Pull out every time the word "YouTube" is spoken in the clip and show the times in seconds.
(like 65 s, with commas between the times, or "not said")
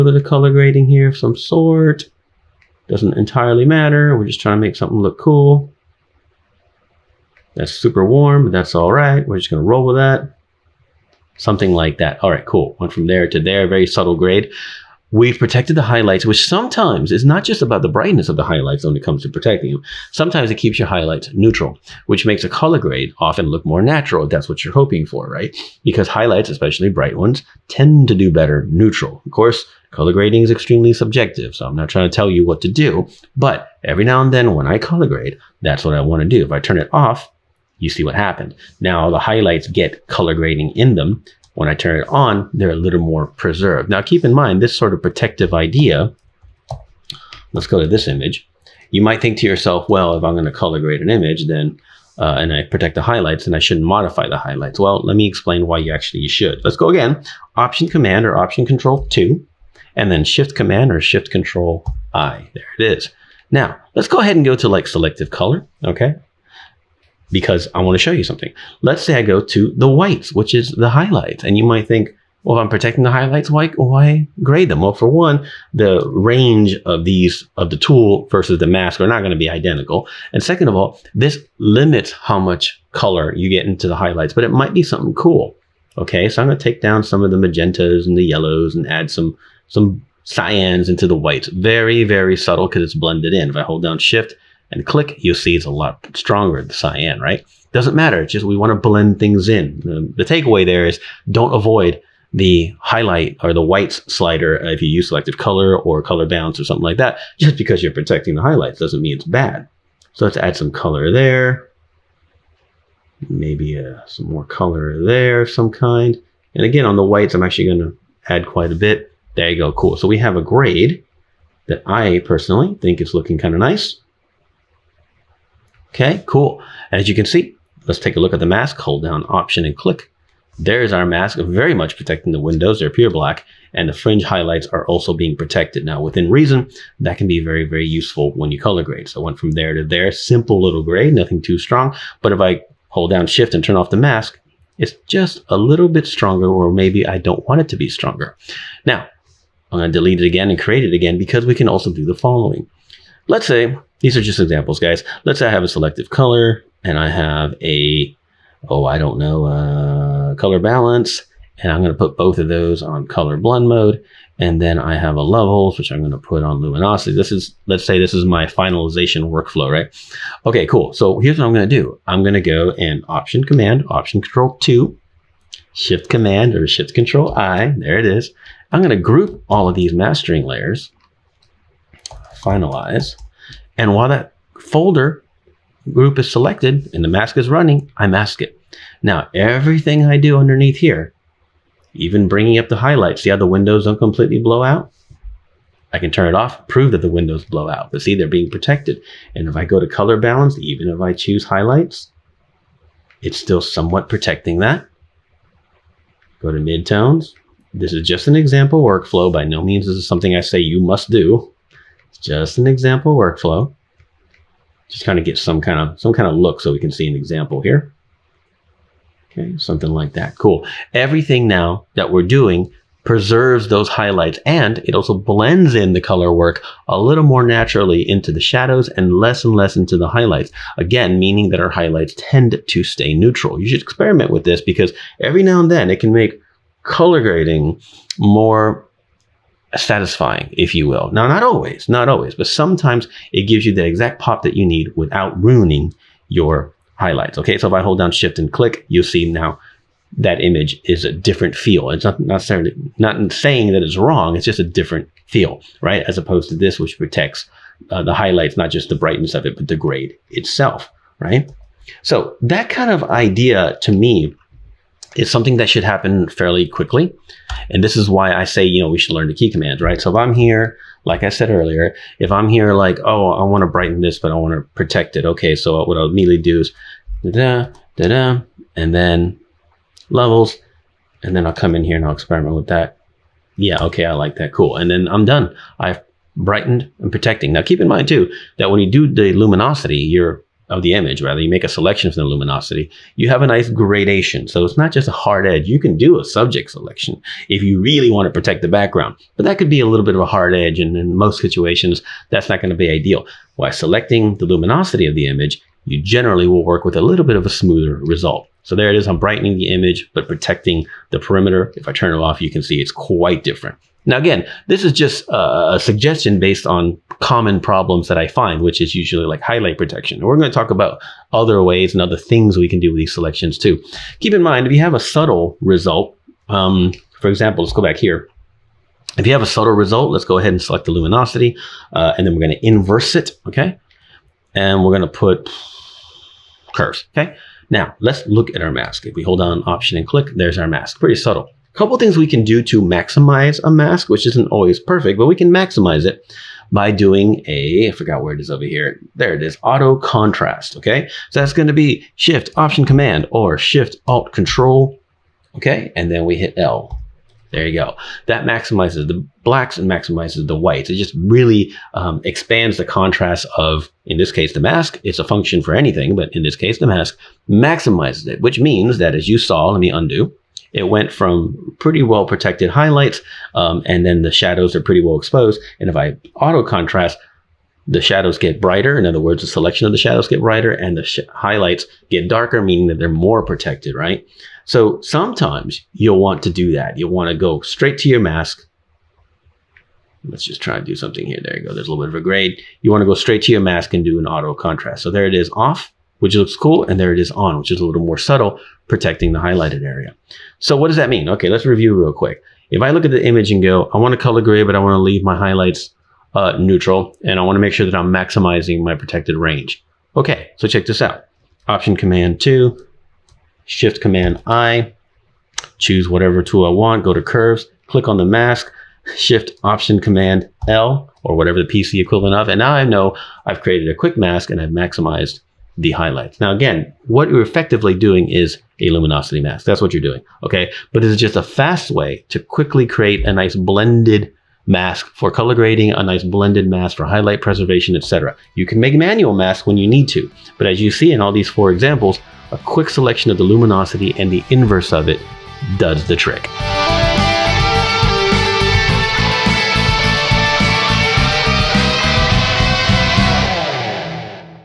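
not said.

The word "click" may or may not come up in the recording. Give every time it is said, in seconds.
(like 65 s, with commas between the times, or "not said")
94 s, 129 s, 248 s, 340 s, 417 s.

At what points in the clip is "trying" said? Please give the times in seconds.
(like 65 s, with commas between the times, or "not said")
4 s, 31 s.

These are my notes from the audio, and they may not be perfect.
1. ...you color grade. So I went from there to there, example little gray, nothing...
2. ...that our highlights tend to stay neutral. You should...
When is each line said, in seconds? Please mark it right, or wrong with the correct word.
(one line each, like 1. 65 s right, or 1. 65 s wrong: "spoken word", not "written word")
1. 138 s wrong: "simple", not "example"
2. 231 s right.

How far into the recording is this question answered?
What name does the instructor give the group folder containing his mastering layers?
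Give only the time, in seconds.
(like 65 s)
182 s.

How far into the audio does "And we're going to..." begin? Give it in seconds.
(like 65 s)
334 s.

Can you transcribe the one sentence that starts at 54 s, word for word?
Well, let me explain why you actually should.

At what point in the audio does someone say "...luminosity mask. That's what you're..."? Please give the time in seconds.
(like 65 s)
428 s.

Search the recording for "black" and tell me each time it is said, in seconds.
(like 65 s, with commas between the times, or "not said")
133 s, 359 s.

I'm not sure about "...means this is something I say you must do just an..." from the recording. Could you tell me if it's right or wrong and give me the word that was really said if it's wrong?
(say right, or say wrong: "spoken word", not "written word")
right.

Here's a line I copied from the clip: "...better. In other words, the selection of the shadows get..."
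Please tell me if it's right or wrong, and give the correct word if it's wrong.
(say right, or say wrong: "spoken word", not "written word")
wrong: "brighter", not "better".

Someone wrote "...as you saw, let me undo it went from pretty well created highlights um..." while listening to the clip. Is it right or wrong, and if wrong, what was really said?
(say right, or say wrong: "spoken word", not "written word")
wrong: "protected", not "created".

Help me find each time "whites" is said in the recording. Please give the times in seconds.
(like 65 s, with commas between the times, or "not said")
69 s, 91 s, 103 s, 117 s, 360 s.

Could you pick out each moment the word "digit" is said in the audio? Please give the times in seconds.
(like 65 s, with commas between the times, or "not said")
not said.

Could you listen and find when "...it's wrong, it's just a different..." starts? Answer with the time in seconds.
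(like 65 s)
253 s.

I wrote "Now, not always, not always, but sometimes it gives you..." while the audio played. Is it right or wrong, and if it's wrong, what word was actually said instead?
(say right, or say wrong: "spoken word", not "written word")
right.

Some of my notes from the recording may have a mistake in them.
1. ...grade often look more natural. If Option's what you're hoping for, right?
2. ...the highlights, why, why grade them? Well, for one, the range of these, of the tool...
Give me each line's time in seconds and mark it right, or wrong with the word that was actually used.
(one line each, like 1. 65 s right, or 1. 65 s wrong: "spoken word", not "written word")
1. 22 s wrong: "That", not "Option"
2. 73 s right.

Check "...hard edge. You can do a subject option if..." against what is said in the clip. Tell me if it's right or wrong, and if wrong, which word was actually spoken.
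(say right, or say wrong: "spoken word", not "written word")
wrong: "selection", not "option".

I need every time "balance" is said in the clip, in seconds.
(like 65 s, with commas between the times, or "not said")
106 s, 160 s, 200 s.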